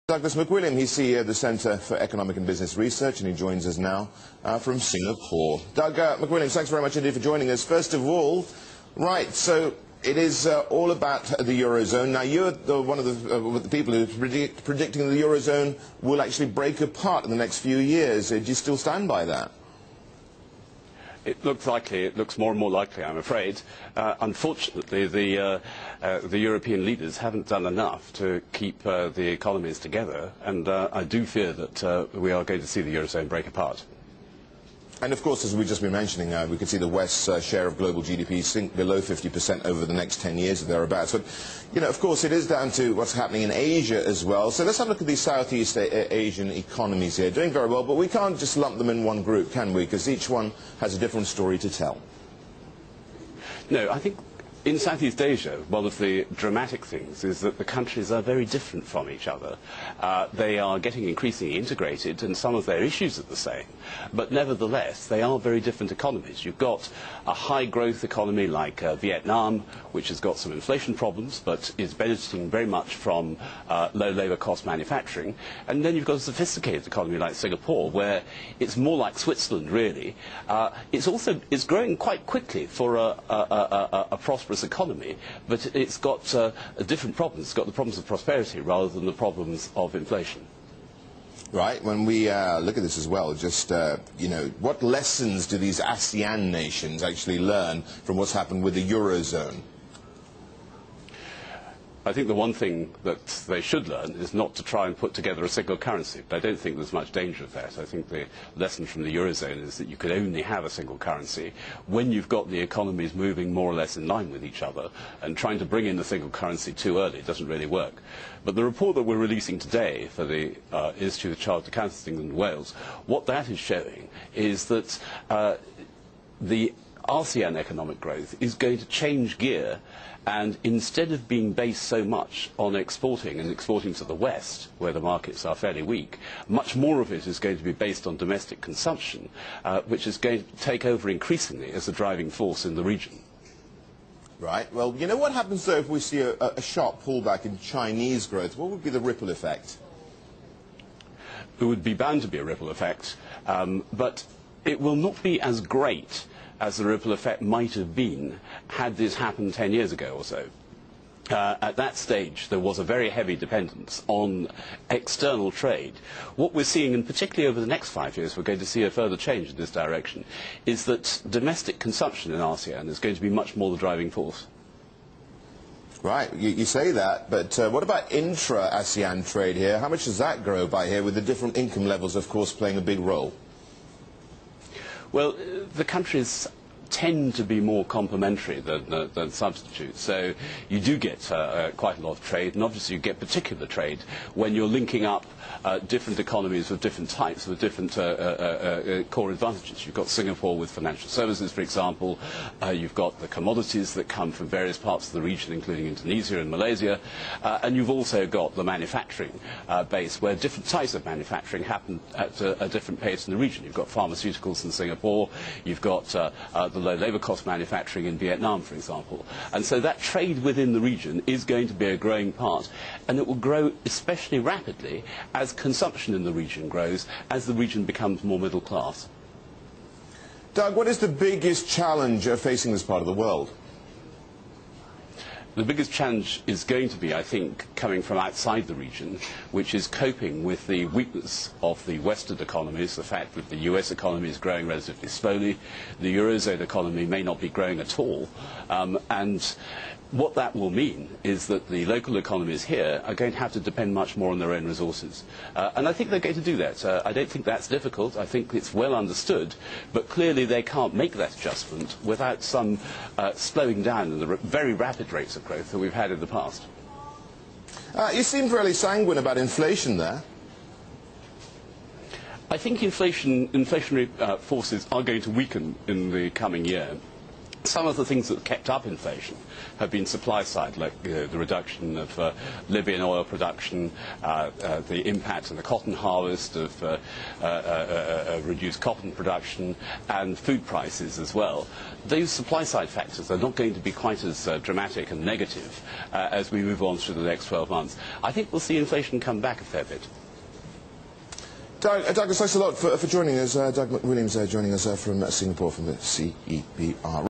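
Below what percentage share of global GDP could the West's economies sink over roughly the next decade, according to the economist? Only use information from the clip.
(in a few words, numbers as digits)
50%.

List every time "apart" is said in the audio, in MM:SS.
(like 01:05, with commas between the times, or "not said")
00:16, 00:33.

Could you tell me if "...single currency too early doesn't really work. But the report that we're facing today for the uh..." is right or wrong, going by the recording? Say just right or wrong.
wrong.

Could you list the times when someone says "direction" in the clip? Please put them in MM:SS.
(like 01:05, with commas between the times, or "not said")
02:49.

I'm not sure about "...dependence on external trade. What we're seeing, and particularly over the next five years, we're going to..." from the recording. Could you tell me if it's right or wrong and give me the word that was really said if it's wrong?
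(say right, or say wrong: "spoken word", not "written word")
right.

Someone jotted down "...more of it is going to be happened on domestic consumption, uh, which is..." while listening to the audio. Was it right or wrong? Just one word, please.
wrong.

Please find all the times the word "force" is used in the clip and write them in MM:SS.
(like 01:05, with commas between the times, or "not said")
02:22, 02:54, 04:34.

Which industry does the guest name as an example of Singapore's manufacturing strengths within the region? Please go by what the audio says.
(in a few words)
Pharmaceuticals.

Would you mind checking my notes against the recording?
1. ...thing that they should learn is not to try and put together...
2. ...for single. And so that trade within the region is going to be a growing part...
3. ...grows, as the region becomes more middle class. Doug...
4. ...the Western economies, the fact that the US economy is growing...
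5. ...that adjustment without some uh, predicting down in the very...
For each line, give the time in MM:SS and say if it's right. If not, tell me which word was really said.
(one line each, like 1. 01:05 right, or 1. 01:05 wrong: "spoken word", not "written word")
1. 01:42 right
2. 03:38 wrong: "example", not "single"
3. 03:46 right
4. 04:01 right
5. 04:21 wrong: "slowing", not "predicting".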